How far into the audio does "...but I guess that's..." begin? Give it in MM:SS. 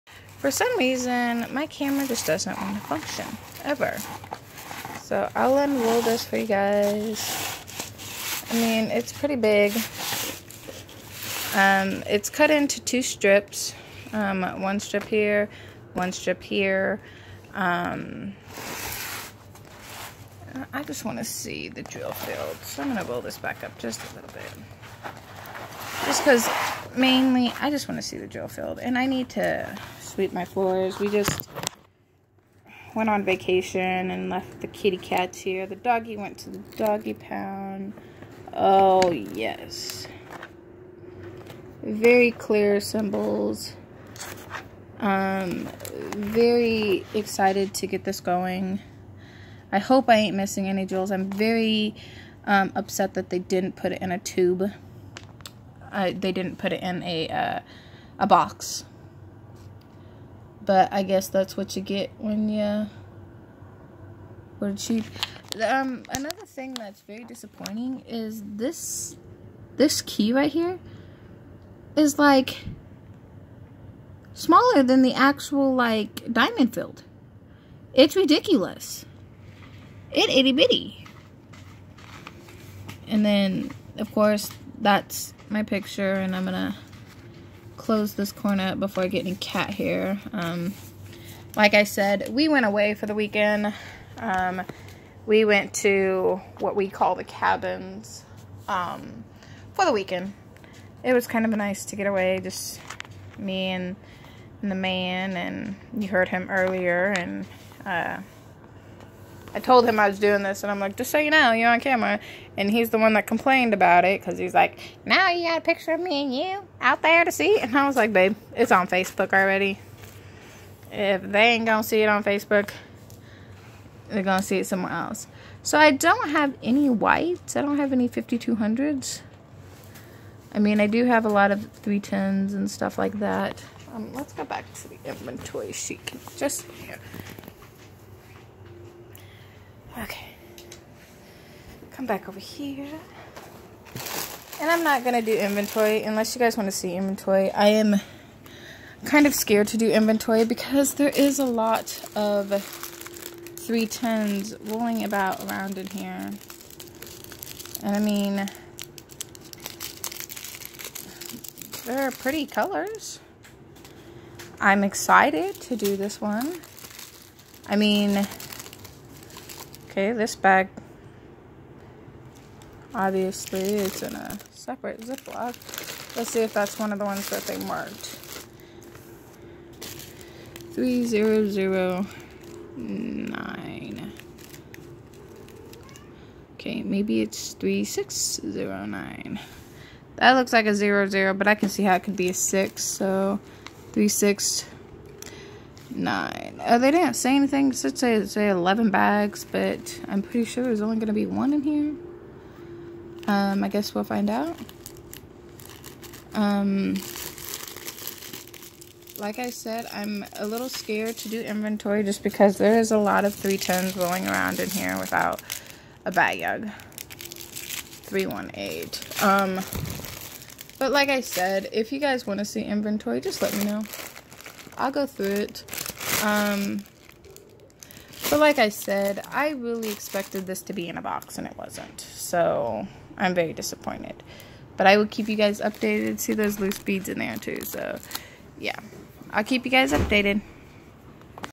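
01:00.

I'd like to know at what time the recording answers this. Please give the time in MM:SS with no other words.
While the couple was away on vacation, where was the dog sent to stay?
00:36.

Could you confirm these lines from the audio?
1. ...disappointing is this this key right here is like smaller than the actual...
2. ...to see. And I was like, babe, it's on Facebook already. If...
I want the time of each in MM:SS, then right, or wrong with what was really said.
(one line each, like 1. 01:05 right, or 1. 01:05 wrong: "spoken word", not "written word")
1. 01:07 right
2. 01:57 right.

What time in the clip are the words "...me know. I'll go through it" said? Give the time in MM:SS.
03:43.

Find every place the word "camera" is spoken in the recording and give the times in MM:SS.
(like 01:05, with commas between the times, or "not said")
00:01, 01:51.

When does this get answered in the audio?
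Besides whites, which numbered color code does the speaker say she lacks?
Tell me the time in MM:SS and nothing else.
02:08.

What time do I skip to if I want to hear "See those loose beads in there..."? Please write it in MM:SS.
03:56.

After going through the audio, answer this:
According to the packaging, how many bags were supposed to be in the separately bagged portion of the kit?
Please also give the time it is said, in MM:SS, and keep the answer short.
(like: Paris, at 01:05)
11, at 03:18.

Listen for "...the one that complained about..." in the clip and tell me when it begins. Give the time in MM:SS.
01:52.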